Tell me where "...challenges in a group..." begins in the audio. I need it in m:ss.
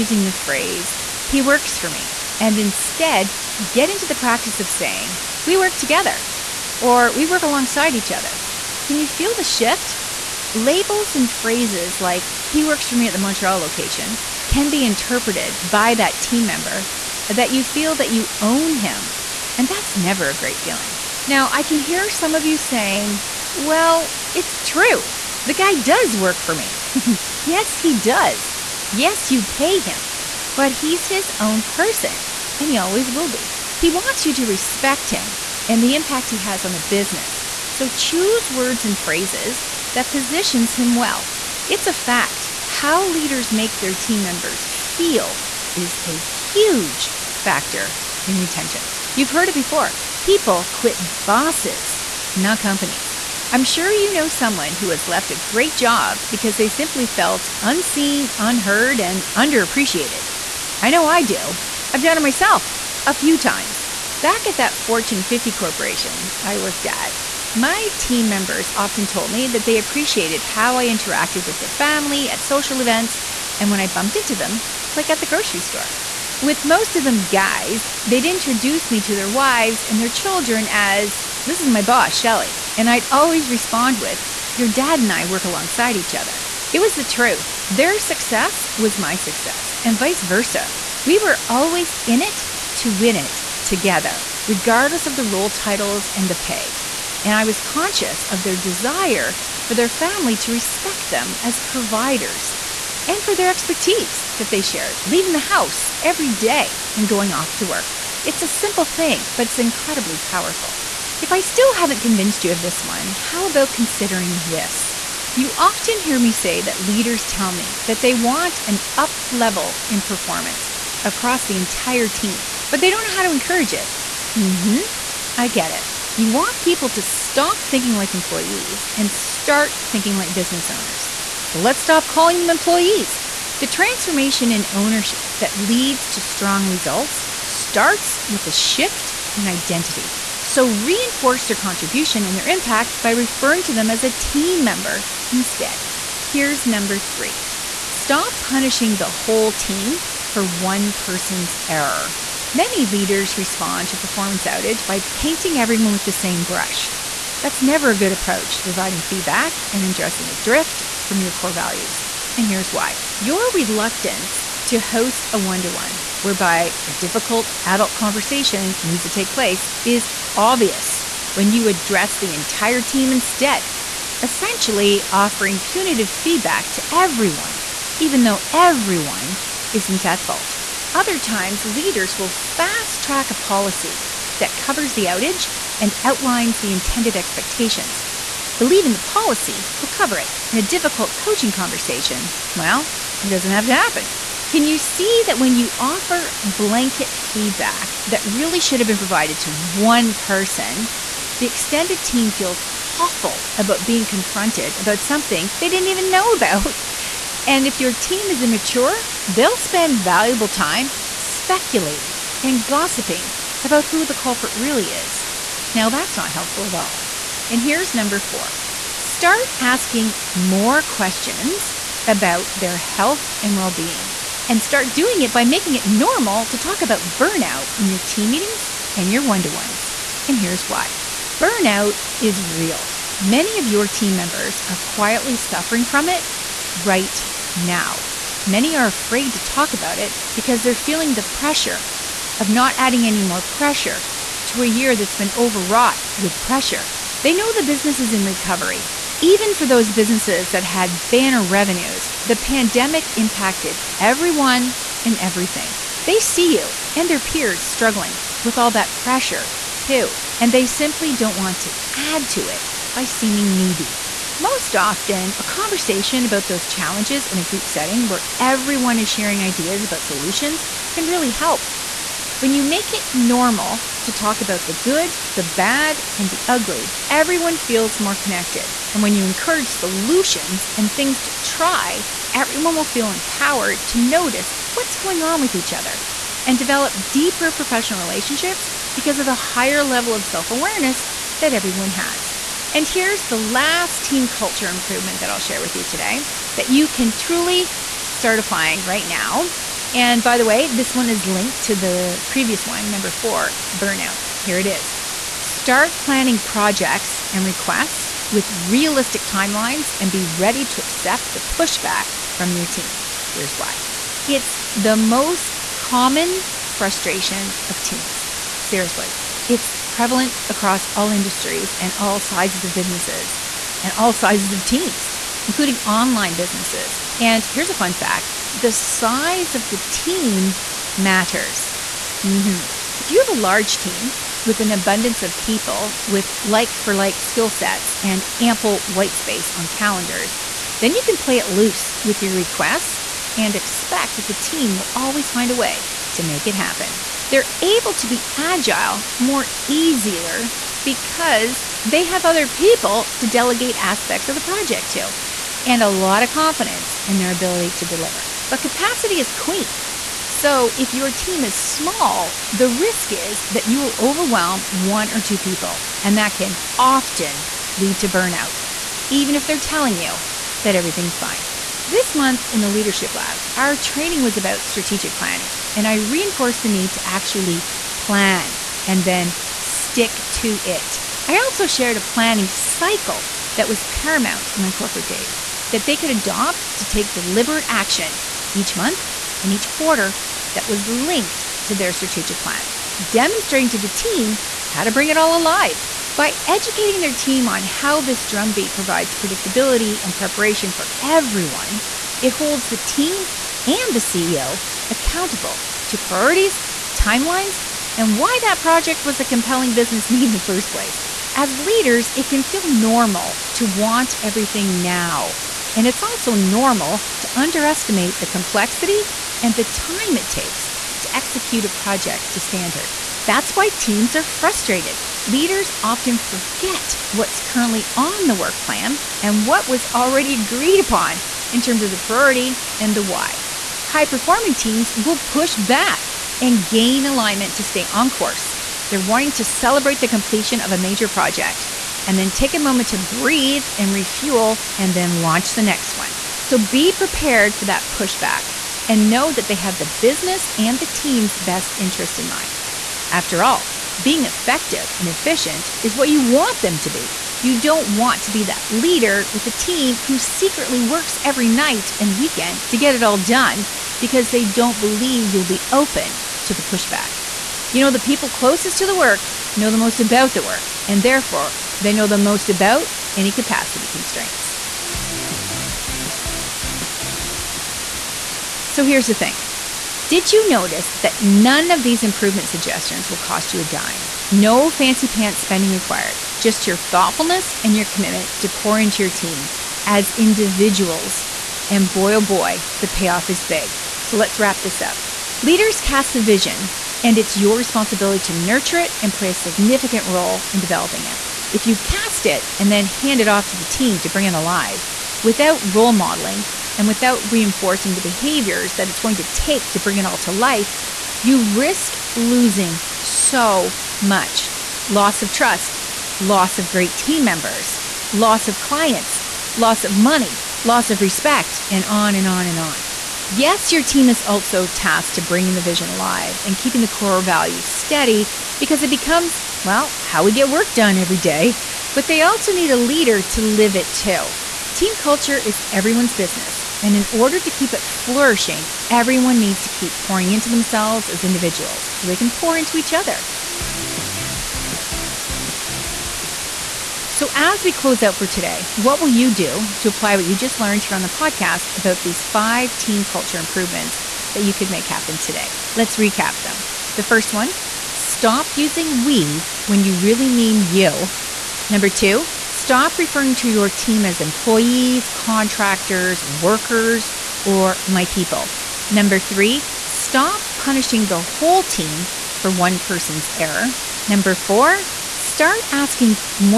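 4:26.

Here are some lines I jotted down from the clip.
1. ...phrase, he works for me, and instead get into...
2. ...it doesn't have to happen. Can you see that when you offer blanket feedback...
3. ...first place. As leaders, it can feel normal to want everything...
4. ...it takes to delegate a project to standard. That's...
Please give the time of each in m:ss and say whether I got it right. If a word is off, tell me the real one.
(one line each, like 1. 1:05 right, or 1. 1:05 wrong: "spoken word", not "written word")
1. 0:00 right
2. 3:13 right
3. 6:50 right
4. 7:00 wrong: "execute", not "delegate".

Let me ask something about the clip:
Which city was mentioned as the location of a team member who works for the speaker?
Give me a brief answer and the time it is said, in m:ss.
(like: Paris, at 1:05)
Montreal, at 0:13.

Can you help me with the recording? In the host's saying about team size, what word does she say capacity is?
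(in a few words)
queen.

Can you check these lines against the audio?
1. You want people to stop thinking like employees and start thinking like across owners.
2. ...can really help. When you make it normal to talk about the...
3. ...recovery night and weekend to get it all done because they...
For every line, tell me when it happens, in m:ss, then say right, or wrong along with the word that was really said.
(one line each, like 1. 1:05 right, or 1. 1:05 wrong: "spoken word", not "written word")
1. 2:06 wrong: "business", not "across"
2. 4:30 right
3. 7:41 wrong: "every", not "recovery".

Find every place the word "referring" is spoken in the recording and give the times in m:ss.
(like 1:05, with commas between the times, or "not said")
2:23, 9:22.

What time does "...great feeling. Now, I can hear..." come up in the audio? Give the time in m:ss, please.
0:20.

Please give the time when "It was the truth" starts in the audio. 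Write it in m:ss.
1:26.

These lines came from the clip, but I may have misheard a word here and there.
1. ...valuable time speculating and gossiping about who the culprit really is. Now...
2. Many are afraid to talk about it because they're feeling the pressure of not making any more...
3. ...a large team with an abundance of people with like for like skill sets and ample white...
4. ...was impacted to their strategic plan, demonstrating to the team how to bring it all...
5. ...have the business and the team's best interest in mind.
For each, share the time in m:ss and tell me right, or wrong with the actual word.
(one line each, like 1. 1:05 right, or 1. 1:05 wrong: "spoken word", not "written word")
1. 3:30 right
2. 3:58 wrong: "adding", not "making"
3. 5:33 right
4. 6:30 wrong: "linked", not "impacted"
5. 7:29 right.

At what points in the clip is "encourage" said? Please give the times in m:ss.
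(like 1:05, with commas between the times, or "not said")
2:03, 4:39.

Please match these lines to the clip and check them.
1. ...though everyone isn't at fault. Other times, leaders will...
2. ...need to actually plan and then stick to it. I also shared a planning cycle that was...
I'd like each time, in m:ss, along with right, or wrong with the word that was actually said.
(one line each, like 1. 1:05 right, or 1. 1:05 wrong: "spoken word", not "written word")
1. 2:58 right
2. 6:16 right.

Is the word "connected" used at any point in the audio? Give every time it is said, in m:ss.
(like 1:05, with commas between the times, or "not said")
4:38.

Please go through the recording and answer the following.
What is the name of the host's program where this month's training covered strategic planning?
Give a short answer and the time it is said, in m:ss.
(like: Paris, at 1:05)
Leadership Lab, at 6:12.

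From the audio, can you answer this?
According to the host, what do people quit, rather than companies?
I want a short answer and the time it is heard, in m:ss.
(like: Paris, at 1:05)
bosses, at 0:51.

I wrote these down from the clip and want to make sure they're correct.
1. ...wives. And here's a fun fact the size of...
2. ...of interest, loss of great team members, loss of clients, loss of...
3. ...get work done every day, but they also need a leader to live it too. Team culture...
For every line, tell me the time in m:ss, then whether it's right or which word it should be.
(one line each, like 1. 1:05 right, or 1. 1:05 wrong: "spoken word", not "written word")
1. 5:26 wrong: "businesses", not "wives"
2. 8:35 wrong: "trust", not "interest"
3. 8:50 right.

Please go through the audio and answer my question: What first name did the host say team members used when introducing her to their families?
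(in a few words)
Shelli.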